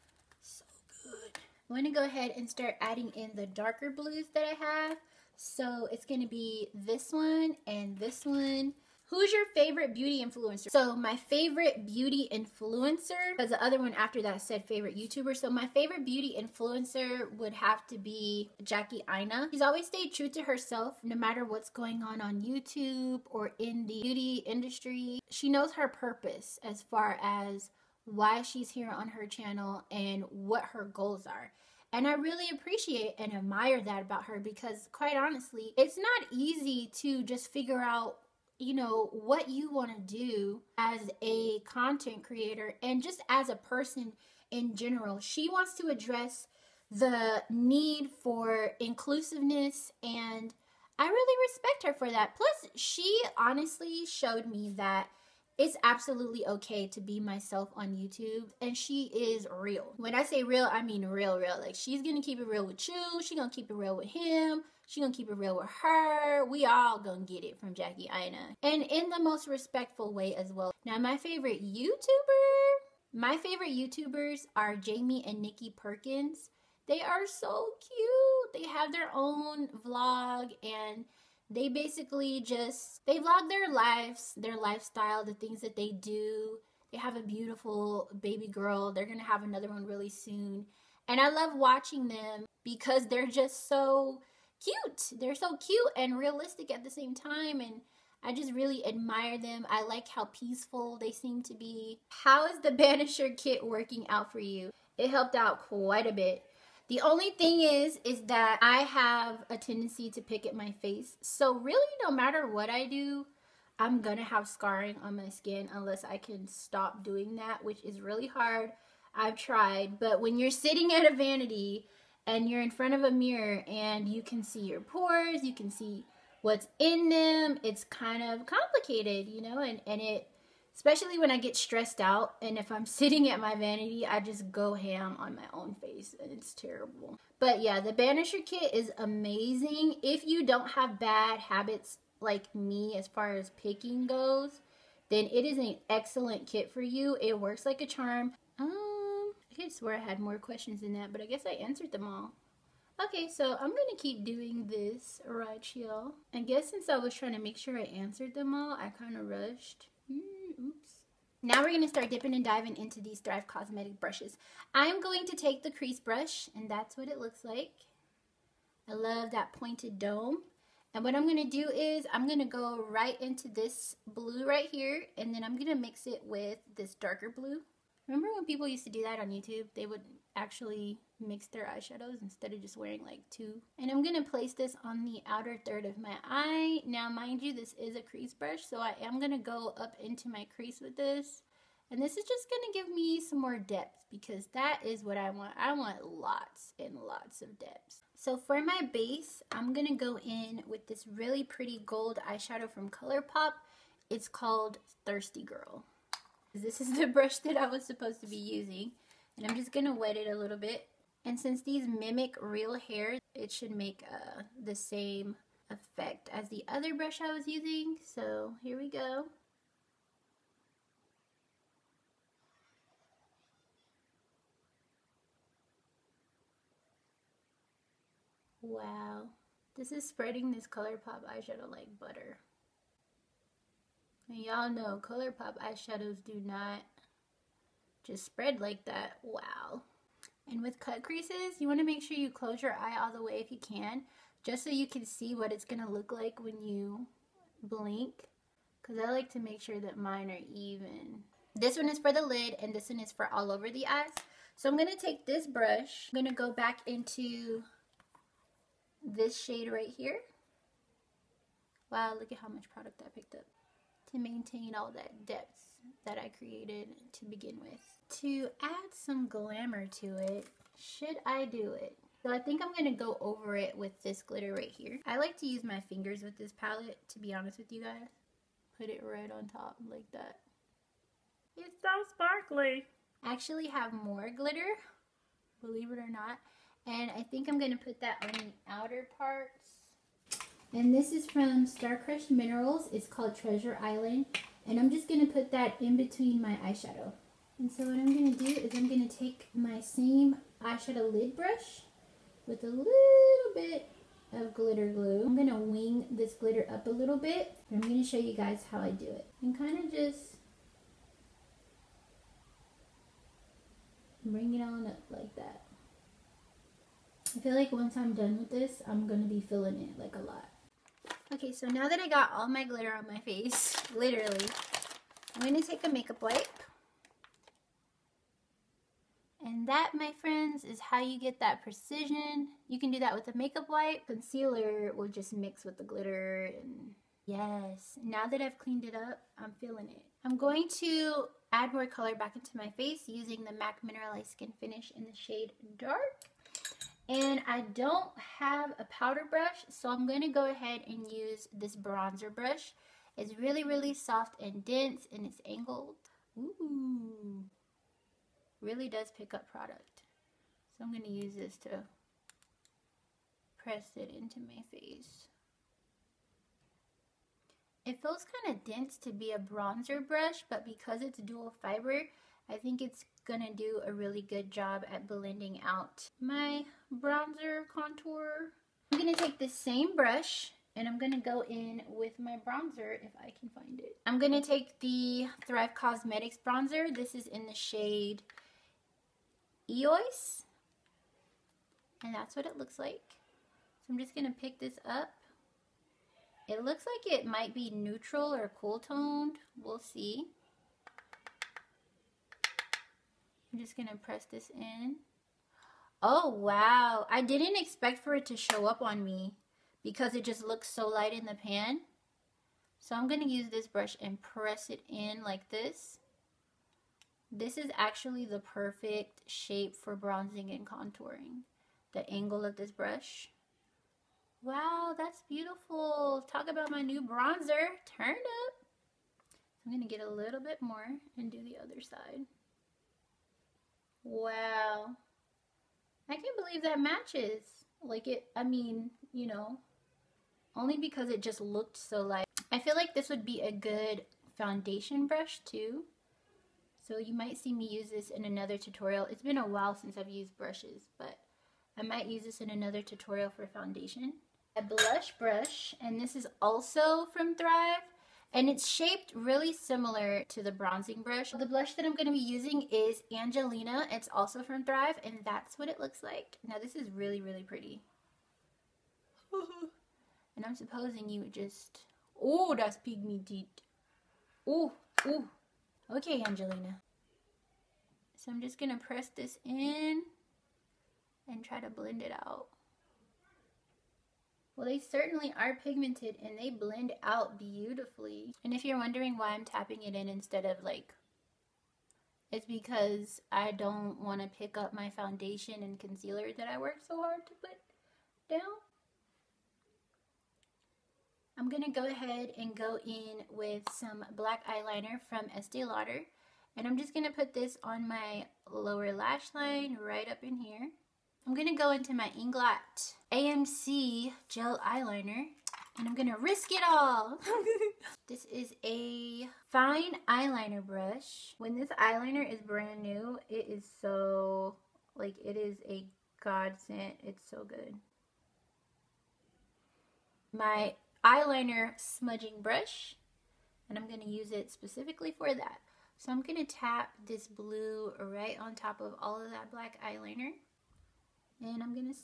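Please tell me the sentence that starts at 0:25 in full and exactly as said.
She knows her purpose as far as why she's here on her channel and what her goals are.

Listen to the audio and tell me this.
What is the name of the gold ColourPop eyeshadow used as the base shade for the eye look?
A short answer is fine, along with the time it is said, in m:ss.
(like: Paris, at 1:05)
Thirsty Girl, at 3:25.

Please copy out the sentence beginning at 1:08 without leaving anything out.
And in the most respectful way as well.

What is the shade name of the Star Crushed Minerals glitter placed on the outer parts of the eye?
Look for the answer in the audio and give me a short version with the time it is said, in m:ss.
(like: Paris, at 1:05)
Treasure Island, at 4:53.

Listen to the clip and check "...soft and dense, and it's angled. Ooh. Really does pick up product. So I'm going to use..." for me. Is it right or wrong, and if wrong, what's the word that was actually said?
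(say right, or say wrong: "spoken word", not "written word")
right.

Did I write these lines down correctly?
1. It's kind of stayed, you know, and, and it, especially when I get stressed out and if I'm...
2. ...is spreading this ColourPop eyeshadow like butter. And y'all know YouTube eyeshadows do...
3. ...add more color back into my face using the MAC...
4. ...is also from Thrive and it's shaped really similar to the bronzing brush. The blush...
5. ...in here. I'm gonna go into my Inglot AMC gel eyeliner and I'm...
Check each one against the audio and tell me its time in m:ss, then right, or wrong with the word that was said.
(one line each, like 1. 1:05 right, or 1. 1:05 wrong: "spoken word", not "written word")
1. 2:07 wrong: "complicated", not "stayed"
2. 3:49 wrong: "ColourPop", not "YouTube"
3. 5:41 right
4. 7:36 right
5. 8:30 right.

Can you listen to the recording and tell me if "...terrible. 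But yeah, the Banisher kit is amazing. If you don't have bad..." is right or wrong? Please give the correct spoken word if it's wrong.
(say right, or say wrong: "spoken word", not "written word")
right.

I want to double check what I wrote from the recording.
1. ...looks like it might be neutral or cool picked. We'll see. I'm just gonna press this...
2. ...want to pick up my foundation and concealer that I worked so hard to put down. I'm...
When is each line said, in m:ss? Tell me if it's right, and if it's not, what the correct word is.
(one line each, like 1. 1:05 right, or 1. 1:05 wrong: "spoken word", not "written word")
1. 6:36 wrong: "toned", not "picked"
2. 8:14 right.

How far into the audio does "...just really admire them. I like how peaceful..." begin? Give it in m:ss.
1:38.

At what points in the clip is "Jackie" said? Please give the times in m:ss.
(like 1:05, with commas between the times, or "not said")
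0:18, 1:07.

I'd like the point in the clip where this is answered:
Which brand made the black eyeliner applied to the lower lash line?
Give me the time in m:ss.
8:25.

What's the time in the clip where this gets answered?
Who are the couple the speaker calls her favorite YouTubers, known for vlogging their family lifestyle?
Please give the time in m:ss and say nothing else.
1:14.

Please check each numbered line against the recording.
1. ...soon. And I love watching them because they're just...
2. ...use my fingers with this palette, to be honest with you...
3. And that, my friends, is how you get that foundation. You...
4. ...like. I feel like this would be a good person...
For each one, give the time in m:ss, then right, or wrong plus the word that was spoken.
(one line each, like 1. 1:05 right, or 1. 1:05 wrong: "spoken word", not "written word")
1. 1:30 right
2. 4:35 right
3. 5:29 wrong: "precision", not "foundation"
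4. 7:22 wrong: "foundation", not "person".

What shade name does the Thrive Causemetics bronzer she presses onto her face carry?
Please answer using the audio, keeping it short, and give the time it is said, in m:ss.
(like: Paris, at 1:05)
Eos, at 6:29.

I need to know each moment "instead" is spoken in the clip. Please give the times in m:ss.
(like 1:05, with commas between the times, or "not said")
3:02, 8:10.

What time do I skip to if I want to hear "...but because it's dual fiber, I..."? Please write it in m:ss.
6:10.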